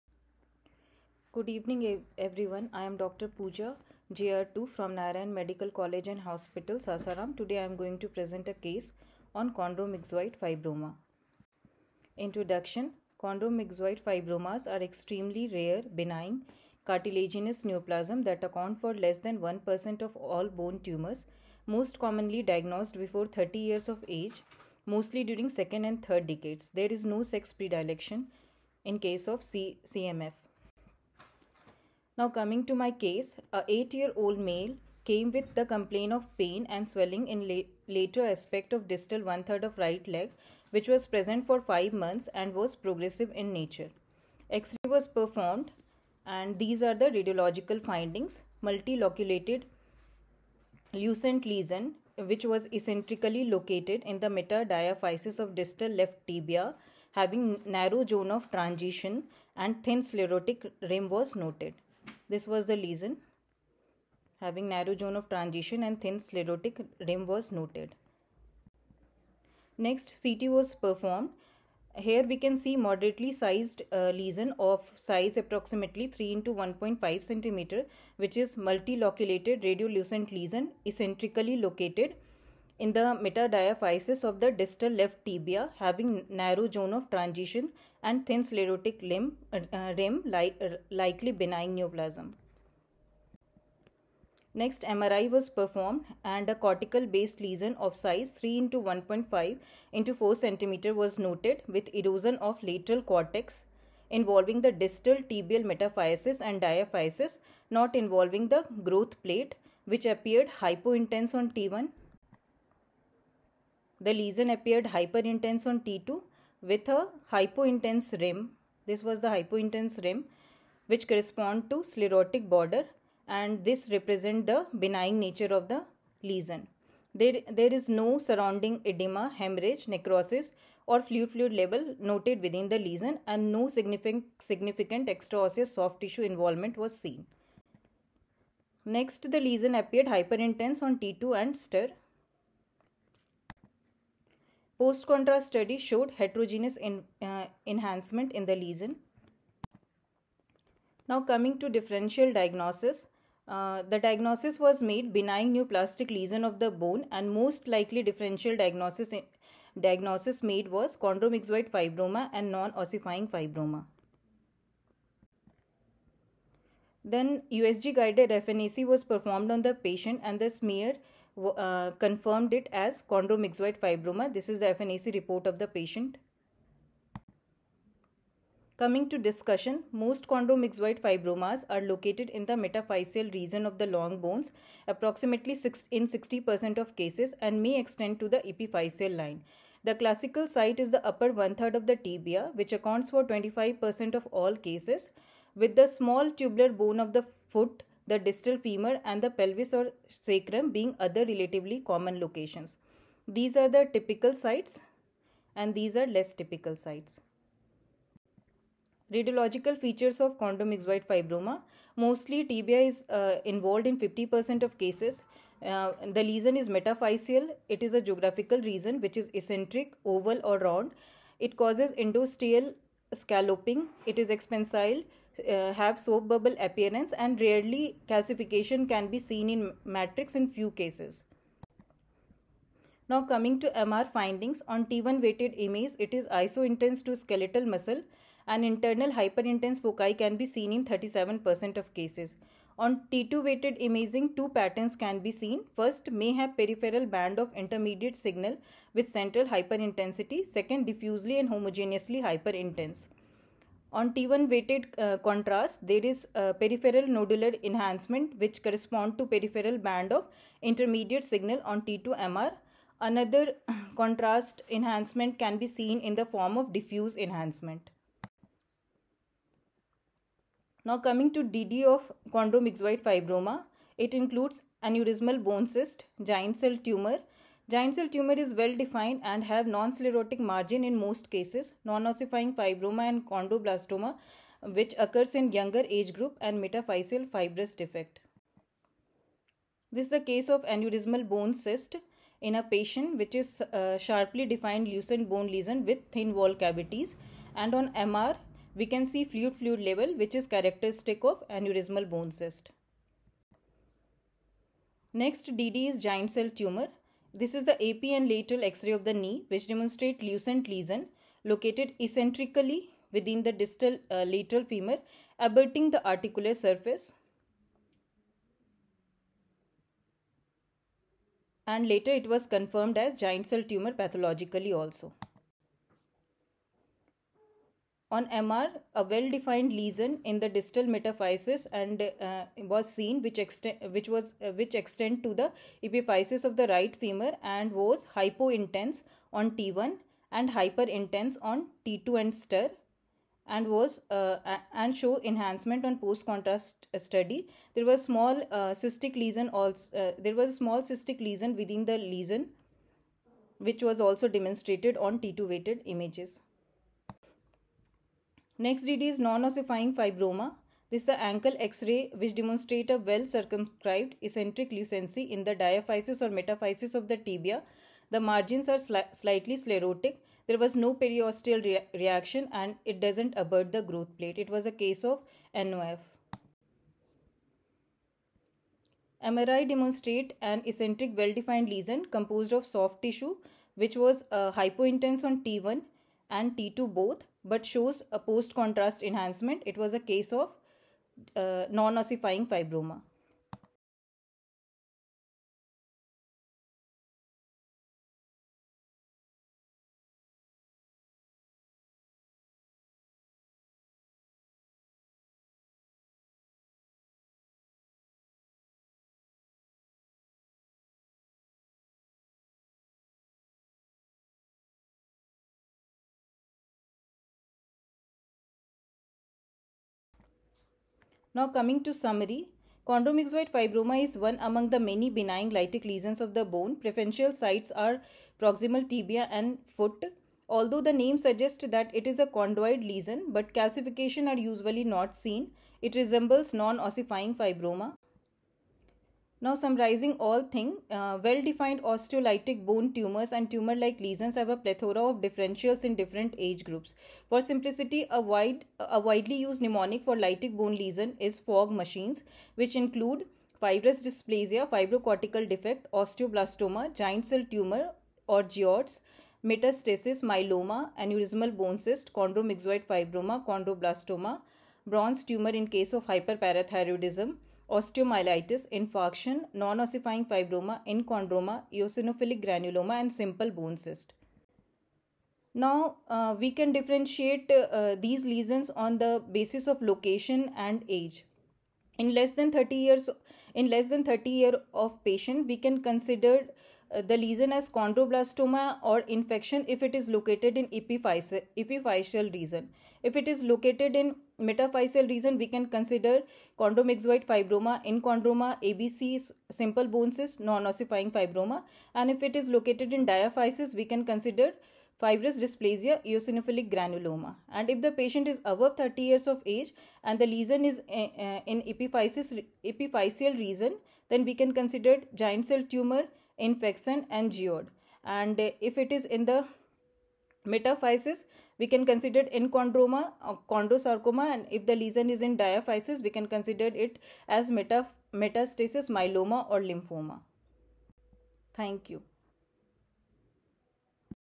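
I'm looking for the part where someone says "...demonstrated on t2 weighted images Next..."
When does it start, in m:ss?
5:54.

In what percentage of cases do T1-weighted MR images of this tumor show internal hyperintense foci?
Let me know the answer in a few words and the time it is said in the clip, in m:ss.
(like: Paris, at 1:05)
37%, at 4:00.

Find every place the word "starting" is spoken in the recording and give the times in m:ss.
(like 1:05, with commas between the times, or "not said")
not said.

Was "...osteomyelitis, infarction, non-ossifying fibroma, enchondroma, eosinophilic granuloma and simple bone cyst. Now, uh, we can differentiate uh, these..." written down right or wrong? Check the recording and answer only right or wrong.
right.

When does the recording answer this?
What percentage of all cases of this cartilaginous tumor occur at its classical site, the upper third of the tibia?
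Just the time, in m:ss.
3:13.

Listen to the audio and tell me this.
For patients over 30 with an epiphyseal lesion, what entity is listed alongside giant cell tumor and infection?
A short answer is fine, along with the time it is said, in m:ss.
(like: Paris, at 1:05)
geode, at 8:37.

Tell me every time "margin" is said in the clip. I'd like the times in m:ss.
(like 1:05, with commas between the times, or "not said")
4:40, 6:08.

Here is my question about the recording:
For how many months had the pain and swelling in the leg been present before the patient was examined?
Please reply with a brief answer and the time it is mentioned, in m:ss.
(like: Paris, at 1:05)
5, at 0:41.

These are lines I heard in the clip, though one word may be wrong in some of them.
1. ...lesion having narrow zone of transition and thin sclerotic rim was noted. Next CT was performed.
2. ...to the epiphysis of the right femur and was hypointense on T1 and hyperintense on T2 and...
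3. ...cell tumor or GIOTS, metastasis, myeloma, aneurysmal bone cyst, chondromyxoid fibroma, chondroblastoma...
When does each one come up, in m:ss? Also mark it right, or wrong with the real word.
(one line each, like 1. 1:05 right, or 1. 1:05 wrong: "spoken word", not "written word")
1. 1:02 right
2. 5:35 right
3. 7:37 right.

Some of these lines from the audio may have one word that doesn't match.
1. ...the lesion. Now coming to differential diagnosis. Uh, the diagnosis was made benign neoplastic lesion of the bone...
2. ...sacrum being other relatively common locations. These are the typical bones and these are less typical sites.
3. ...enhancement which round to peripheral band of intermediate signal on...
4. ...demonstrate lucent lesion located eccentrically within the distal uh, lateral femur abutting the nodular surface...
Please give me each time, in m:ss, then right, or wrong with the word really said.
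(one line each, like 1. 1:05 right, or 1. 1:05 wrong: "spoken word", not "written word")
1. 2:28 right
2. 3:20 wrong: "sites", not "bones"
3. 4:17 wrong: "correspond", not "round"
4. 5:09 wrong: "articular", not "nodular".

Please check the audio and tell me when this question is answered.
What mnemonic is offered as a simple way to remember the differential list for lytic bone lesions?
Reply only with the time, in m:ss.
7:31.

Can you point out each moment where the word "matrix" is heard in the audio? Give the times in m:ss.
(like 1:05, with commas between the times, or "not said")
3:49.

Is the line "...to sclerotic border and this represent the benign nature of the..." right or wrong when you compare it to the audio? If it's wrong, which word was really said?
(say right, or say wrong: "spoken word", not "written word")
right.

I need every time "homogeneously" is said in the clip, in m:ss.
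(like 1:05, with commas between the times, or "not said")
4:11.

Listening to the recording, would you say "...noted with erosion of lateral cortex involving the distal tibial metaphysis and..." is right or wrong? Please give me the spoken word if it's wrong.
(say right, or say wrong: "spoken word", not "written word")
right.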